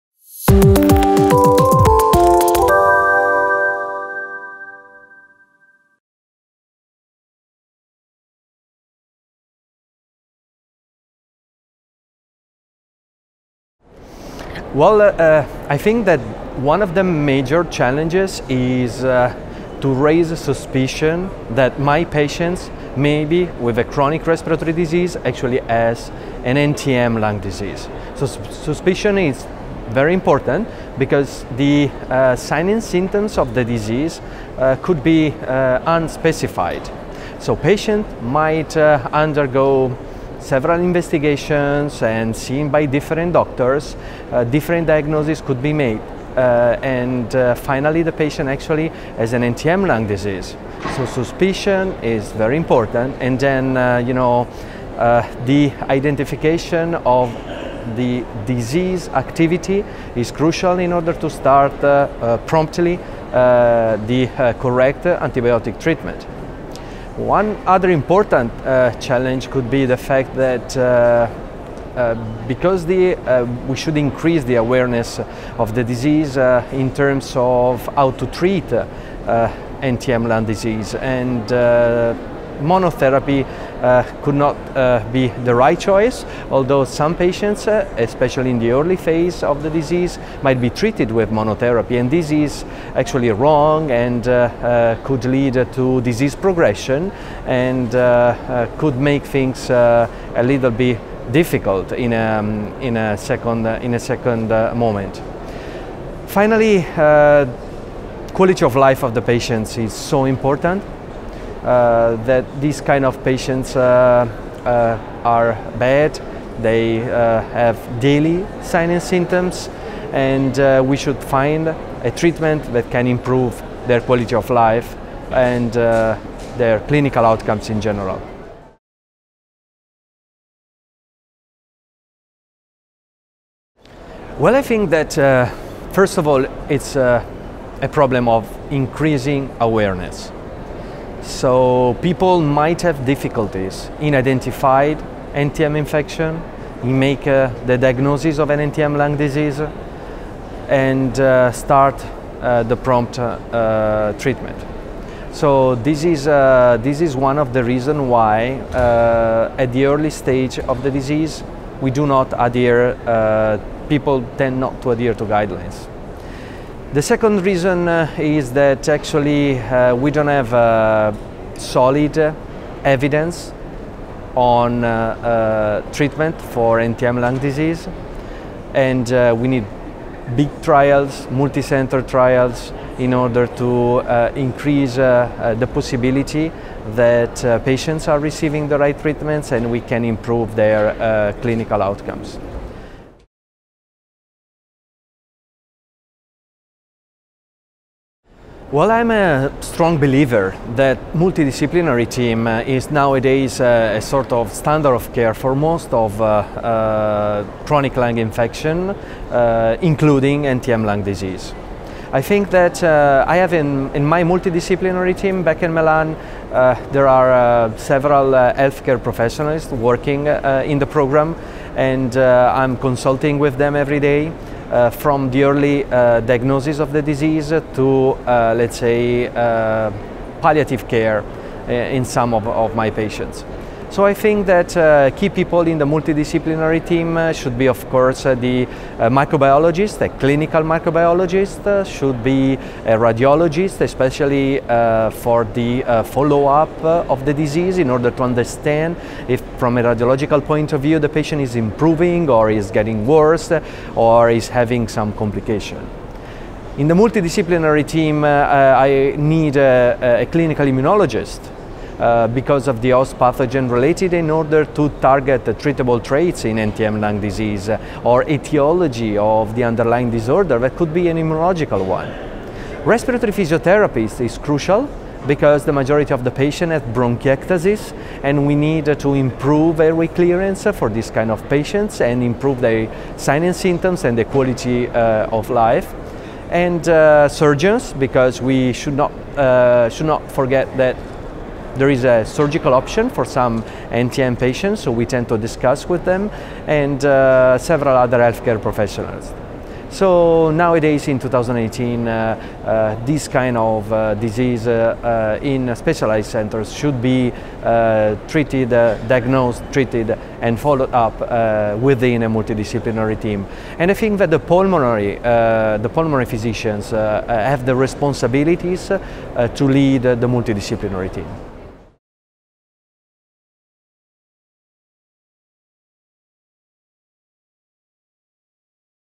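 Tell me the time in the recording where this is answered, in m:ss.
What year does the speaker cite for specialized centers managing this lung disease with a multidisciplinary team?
5:01.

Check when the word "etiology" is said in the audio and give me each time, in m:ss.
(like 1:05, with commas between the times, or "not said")
4:28.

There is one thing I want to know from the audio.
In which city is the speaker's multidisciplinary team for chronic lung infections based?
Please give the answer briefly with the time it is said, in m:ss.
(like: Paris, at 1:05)
Milan, at 3:35.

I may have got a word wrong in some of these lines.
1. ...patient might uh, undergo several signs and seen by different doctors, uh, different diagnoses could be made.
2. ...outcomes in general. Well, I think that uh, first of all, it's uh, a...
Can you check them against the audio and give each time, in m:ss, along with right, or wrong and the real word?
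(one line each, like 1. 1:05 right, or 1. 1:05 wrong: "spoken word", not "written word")
1. 0:37 wrong: "investigations", not "signs"
2. 2:07 right.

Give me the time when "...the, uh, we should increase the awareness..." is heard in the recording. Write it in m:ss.
1:12.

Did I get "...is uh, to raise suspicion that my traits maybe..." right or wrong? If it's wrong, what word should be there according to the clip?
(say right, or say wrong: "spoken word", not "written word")
wrong: "patients", not "traits".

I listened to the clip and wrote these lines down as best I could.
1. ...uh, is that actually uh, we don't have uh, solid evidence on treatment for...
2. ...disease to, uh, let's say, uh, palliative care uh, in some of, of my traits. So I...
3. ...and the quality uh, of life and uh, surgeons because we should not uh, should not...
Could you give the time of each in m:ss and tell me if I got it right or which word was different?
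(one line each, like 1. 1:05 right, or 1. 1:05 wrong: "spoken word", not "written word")
1. 2:47 right
2. 3:47 wrong: "patients", not "traits"
3. 4:44 right.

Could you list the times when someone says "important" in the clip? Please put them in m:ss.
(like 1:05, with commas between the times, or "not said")
0:30, 0:52, 1:07, 1:50.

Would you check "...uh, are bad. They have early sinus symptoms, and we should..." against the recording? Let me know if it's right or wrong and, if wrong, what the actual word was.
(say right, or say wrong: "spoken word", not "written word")
wrong: "daily", not "early".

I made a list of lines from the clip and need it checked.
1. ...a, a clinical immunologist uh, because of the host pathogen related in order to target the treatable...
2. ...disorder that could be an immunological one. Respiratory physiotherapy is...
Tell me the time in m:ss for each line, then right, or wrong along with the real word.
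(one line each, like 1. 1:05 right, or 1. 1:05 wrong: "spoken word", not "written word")
1. 4:19 right
2. 4:30 right.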